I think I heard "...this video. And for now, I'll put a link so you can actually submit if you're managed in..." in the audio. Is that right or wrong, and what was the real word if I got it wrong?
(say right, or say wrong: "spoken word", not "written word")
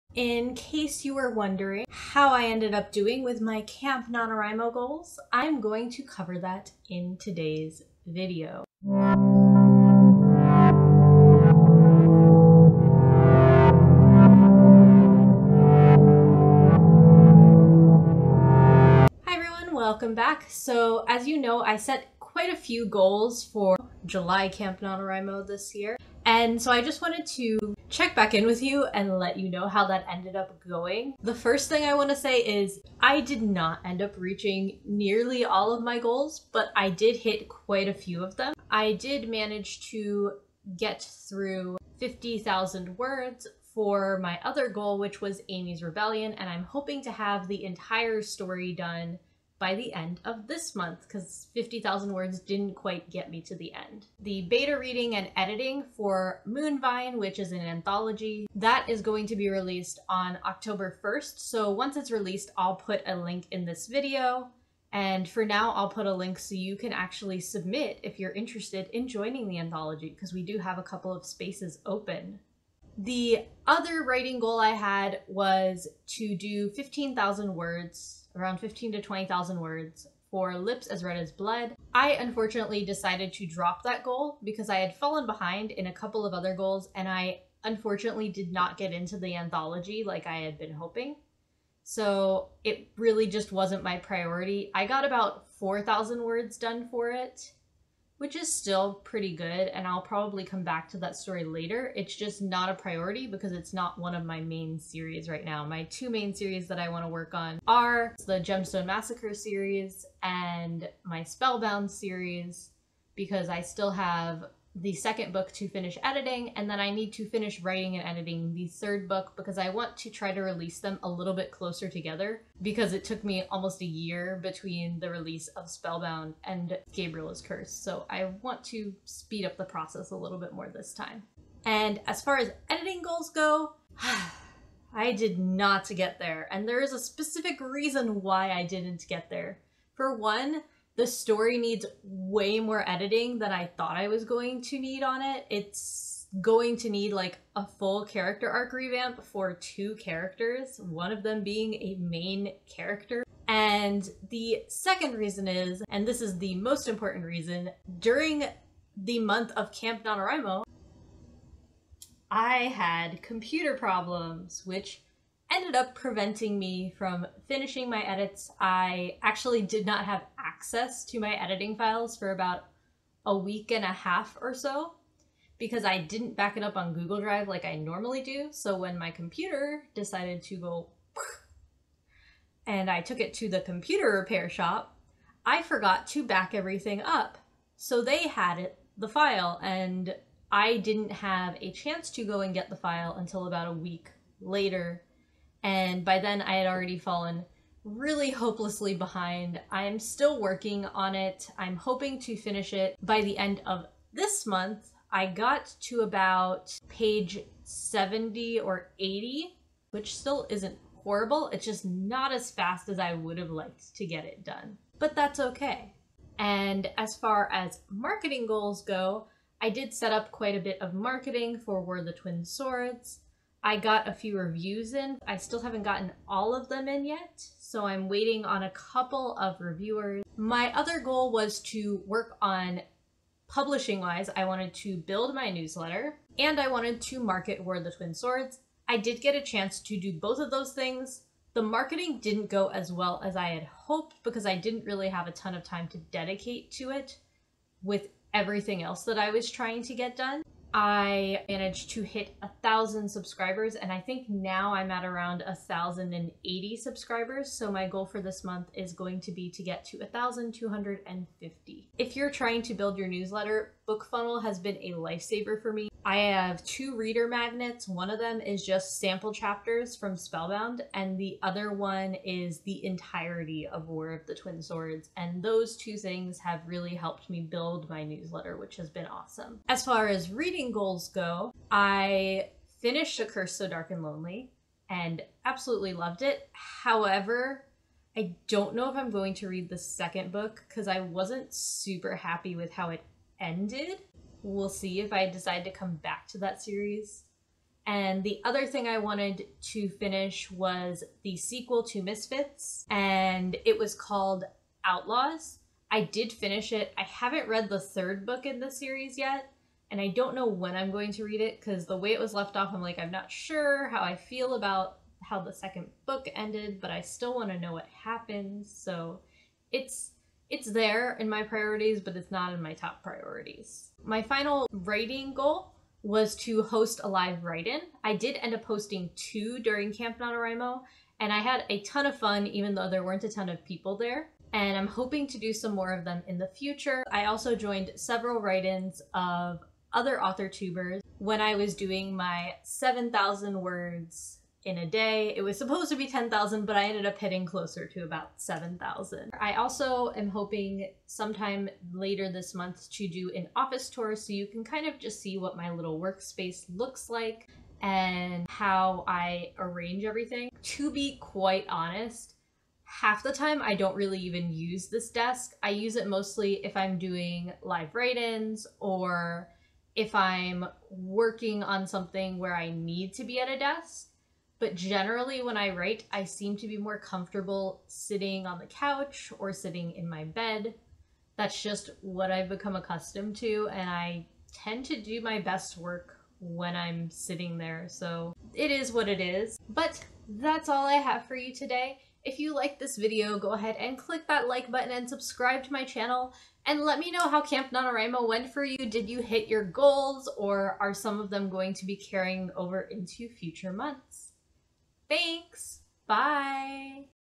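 wrong: "interested", not "managed".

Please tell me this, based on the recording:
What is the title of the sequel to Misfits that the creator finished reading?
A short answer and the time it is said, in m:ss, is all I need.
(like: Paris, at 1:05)
Outlaws, at 5:04.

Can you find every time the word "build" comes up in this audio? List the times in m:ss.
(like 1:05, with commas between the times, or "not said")
3:54, 4:22, 4:37.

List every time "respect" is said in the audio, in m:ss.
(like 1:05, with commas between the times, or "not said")
not said.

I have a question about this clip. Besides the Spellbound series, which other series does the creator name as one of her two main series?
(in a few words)
Gemstone Massacre.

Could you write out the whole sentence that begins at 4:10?
I managed to hit a thousand subscribers, and I think now I'm at around a thousand and eighty subscribers.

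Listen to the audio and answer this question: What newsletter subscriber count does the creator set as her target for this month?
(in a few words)
1,250.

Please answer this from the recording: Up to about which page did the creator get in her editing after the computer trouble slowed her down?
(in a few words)
page 70 or 80.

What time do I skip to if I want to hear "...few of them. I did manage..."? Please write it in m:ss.
0:37.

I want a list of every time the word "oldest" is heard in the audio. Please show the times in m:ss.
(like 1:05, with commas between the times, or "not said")
not said.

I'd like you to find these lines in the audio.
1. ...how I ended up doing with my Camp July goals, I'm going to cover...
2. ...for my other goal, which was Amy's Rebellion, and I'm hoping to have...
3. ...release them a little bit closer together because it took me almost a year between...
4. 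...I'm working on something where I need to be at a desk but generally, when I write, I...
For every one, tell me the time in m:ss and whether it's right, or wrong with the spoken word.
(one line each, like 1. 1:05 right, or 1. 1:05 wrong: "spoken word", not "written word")
1. 0:01 wrong: "NaNoWriMo", not "July"
2. 0:43 right
3. 2:00 right
4. 6:10 right.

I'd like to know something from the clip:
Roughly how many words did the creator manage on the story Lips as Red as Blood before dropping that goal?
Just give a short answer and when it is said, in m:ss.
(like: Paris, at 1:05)
4,000, at 1:35.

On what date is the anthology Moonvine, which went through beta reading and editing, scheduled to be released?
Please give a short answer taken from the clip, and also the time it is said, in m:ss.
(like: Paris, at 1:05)
October 1st, at 1:00.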